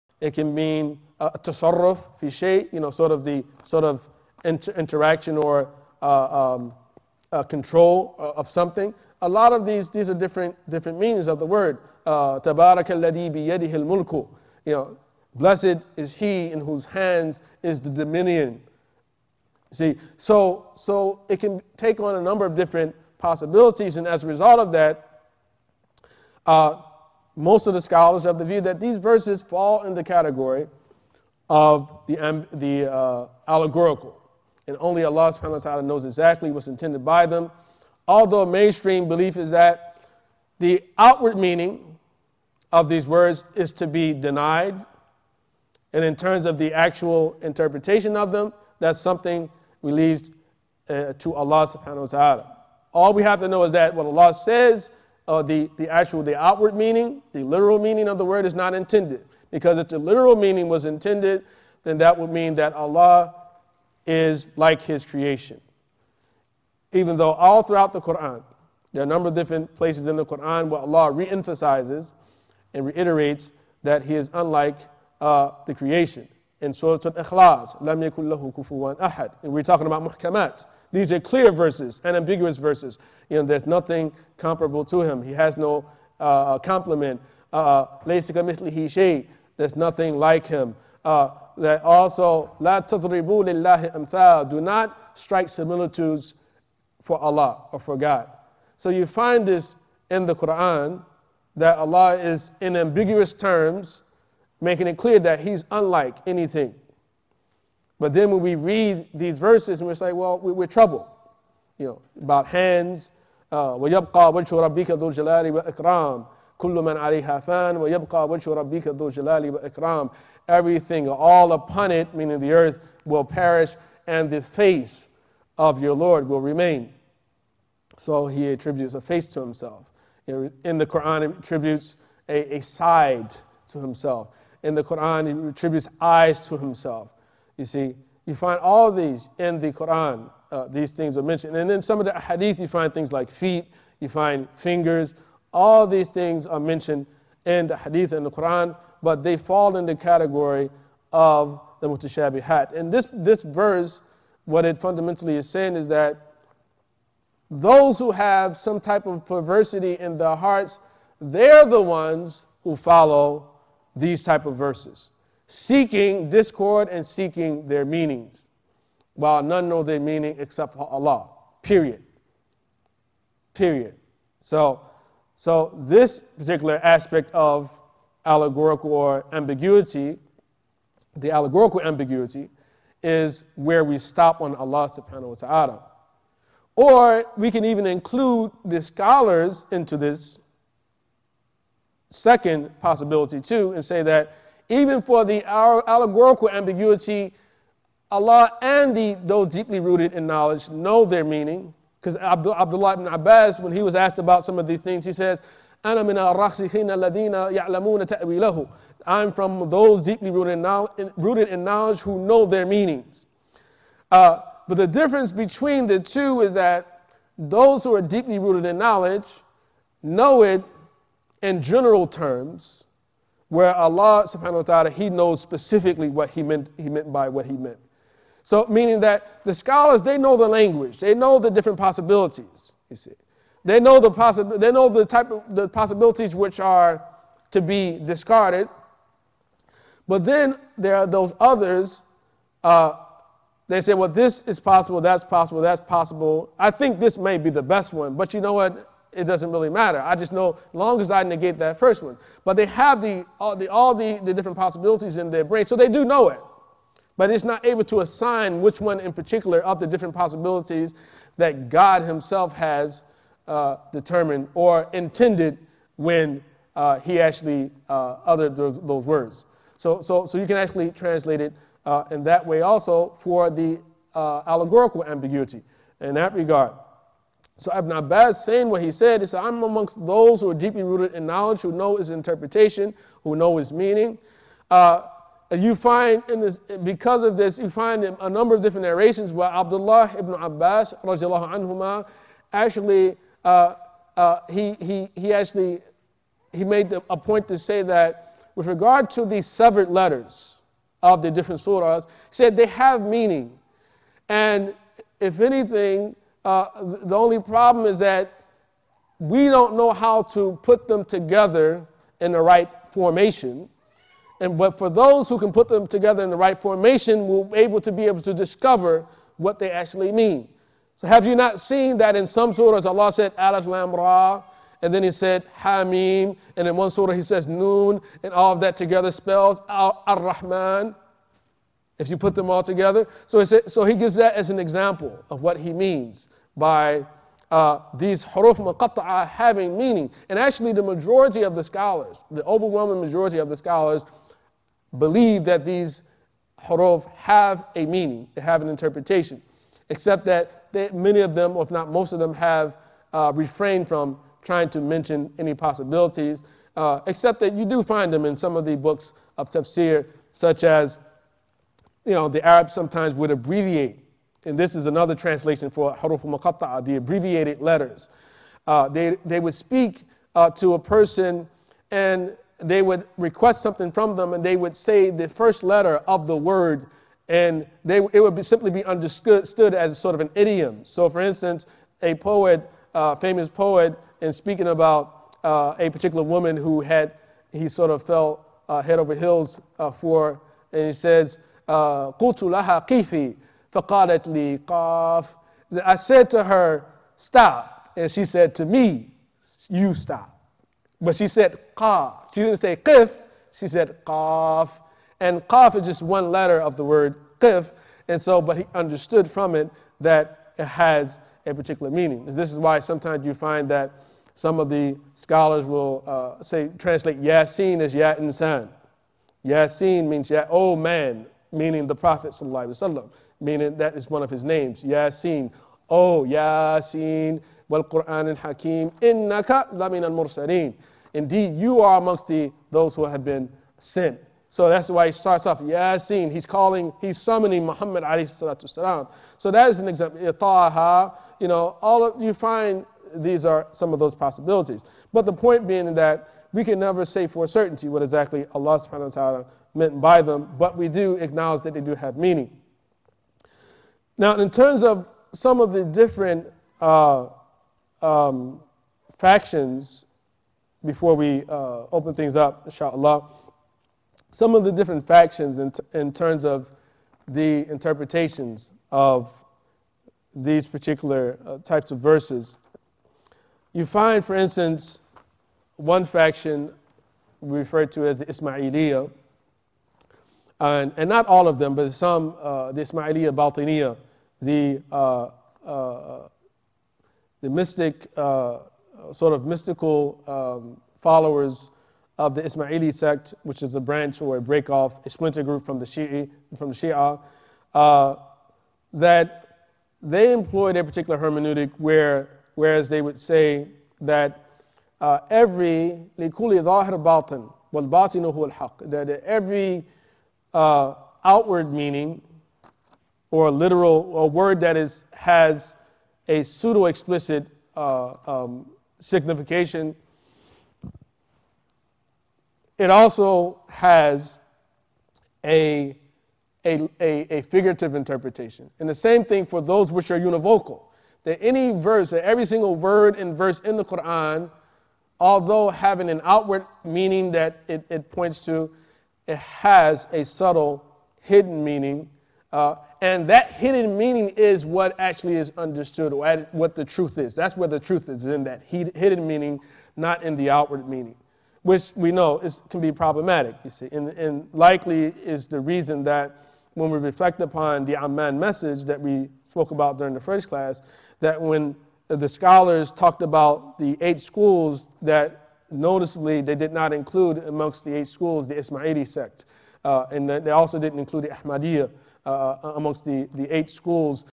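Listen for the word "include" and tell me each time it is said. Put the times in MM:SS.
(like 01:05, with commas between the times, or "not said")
03:07, 09:26, 09:30.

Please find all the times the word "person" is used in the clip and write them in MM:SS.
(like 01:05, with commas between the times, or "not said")
06:10.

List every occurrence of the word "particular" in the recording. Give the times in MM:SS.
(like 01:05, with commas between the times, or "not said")
02:56, 04:19, 06:25, 06:51, 07:50, 08:20.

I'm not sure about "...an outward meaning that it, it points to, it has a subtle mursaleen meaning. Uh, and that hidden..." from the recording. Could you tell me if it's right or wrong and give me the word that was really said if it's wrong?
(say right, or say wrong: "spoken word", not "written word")
wrong: "hidden", not "mursaleen".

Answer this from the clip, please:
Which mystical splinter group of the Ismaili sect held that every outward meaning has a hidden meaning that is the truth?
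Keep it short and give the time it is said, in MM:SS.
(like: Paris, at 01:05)
Ismailiyah Batiniya, at 08:02.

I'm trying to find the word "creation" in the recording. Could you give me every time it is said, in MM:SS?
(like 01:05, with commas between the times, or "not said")
01:05, 01:15.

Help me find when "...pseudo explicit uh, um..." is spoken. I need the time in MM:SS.
08:36.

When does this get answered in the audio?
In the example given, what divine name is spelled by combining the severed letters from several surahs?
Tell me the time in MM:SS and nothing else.
05:29.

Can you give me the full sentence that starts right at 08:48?
And the same thing for those which are univocal.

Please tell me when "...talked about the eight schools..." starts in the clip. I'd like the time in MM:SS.
09:22.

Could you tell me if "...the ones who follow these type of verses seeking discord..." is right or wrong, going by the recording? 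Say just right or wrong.
right.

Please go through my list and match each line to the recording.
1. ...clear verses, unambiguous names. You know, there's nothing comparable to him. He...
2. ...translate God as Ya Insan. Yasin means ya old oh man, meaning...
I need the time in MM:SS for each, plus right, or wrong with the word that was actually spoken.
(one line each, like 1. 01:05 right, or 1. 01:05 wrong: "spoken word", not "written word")
1. 01:21 wrong: "verses", not "names"
2. 06:56 wrong: "Yasin", not "God".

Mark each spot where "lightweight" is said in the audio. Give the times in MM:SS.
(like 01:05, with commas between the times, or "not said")
not said.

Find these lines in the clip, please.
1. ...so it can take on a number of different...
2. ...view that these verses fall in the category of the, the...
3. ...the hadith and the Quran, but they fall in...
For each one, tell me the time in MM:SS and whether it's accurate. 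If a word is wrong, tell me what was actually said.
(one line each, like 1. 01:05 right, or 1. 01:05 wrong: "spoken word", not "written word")
1. 00:20 right
2. 00:28 right
3. 02:27 right.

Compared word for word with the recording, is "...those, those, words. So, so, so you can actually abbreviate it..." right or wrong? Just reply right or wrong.
wrong.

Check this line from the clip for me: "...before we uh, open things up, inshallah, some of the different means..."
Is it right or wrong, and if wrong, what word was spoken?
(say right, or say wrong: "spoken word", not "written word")
wrong: "factions", not "means".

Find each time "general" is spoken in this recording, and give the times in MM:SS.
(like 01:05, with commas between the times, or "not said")
03:41.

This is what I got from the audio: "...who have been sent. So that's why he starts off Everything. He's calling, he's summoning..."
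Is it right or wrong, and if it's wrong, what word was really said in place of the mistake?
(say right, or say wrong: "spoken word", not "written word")
wrong: "Yasin", not "Everything".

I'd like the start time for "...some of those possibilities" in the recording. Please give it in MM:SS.
07:23.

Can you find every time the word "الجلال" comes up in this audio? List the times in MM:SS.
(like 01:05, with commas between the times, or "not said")
01:55, 01:59.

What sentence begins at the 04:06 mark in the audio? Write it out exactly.
I think this may be the best one, but you know what?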